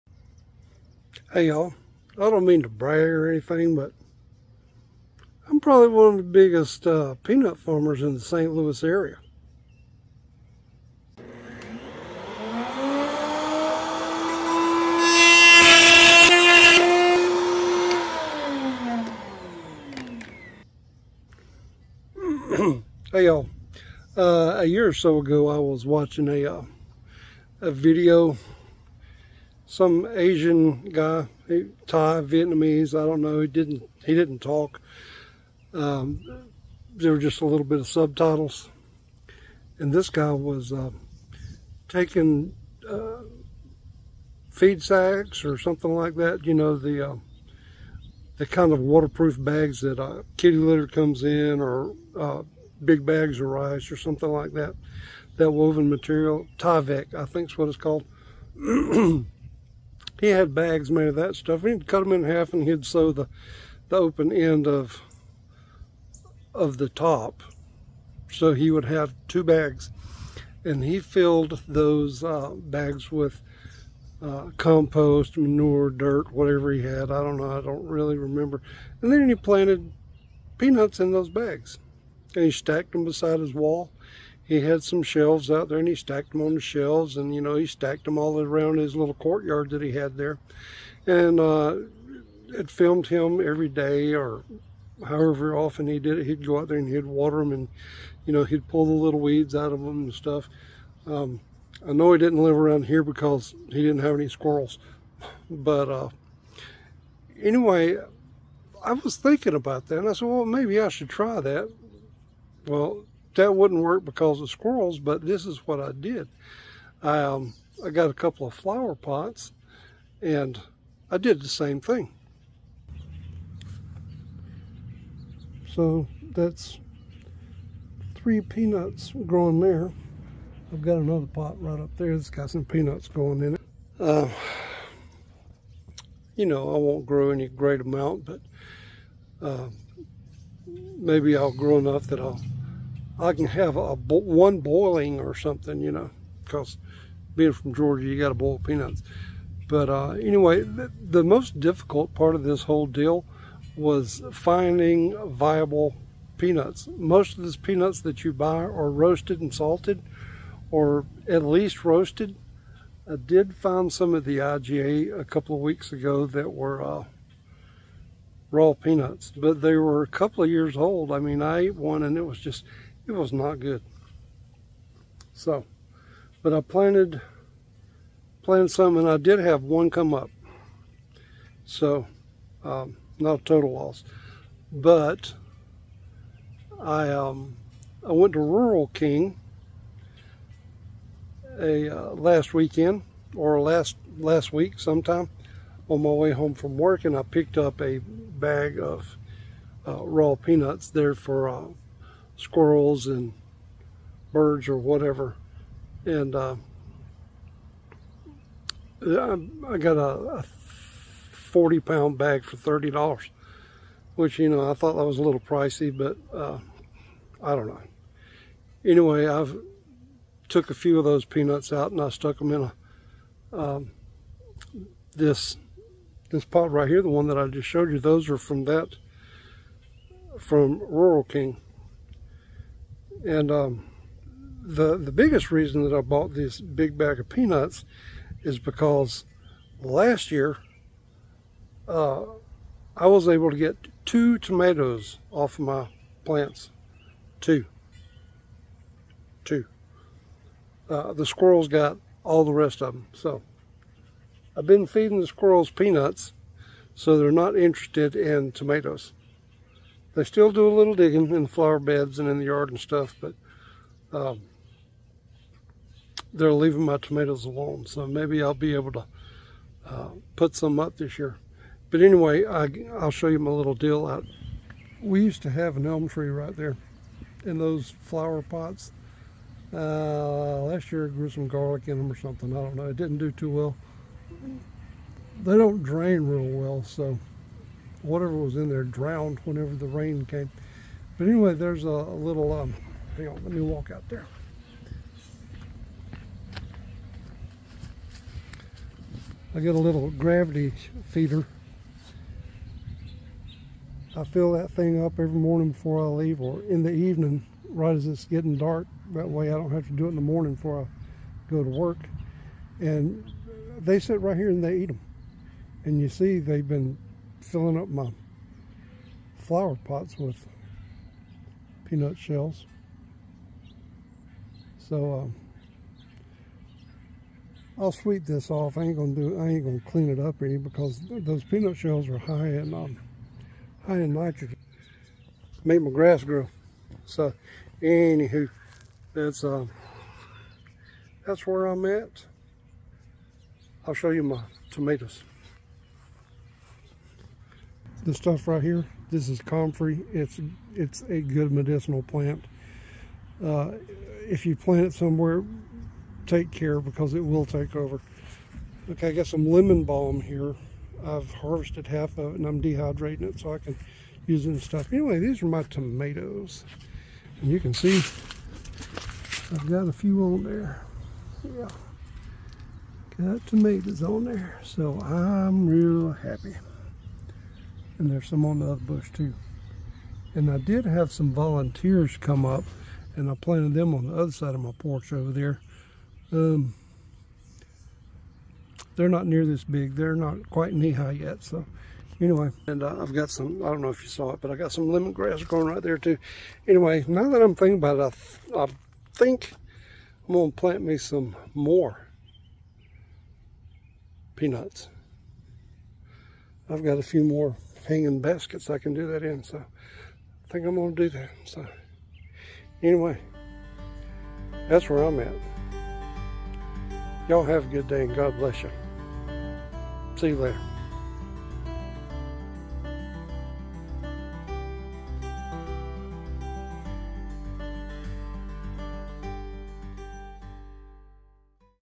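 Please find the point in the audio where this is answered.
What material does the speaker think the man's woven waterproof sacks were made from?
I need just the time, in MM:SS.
00:56.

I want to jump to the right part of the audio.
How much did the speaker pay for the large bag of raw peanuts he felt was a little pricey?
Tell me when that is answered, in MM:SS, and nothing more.
03:32.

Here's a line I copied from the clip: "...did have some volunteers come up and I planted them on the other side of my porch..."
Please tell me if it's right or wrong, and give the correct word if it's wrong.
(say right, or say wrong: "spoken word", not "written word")
right.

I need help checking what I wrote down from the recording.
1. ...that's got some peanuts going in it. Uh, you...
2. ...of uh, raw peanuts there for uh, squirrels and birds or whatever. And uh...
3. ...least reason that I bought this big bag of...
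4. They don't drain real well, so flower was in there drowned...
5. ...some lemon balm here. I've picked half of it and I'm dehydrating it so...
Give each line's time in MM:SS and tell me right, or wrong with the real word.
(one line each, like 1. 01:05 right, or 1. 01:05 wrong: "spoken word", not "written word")
1. 02:12 right
2. 03:18 right
3. 03:55 wrong: "biggest", not "least"
4. 04:45 wrong: "whatever", not "flower"
5. 05:59 wrong: "harvested", not "picked".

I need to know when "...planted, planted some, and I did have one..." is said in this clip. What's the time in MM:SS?
02:56.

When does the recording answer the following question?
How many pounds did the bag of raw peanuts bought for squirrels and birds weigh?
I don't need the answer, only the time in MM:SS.
03:30.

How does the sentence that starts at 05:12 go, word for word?
And they sit right here and they eat them.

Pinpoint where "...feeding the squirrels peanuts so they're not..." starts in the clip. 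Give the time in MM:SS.
04:14.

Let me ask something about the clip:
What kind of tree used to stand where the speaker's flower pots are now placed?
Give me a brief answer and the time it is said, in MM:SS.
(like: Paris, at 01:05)
elm, at 04:35.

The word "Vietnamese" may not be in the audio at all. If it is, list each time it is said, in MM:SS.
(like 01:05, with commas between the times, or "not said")
00:32.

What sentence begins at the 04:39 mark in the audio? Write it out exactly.
Uh, last year I grew some garlic in them or something.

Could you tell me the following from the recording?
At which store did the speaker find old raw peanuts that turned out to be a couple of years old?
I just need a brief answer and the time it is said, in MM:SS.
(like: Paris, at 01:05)
IGA, at 02:44.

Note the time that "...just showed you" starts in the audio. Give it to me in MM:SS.
03:47.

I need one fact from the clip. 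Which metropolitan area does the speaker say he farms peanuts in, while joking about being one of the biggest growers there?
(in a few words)
St. Louis.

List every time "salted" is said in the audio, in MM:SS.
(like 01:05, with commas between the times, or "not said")
02:39.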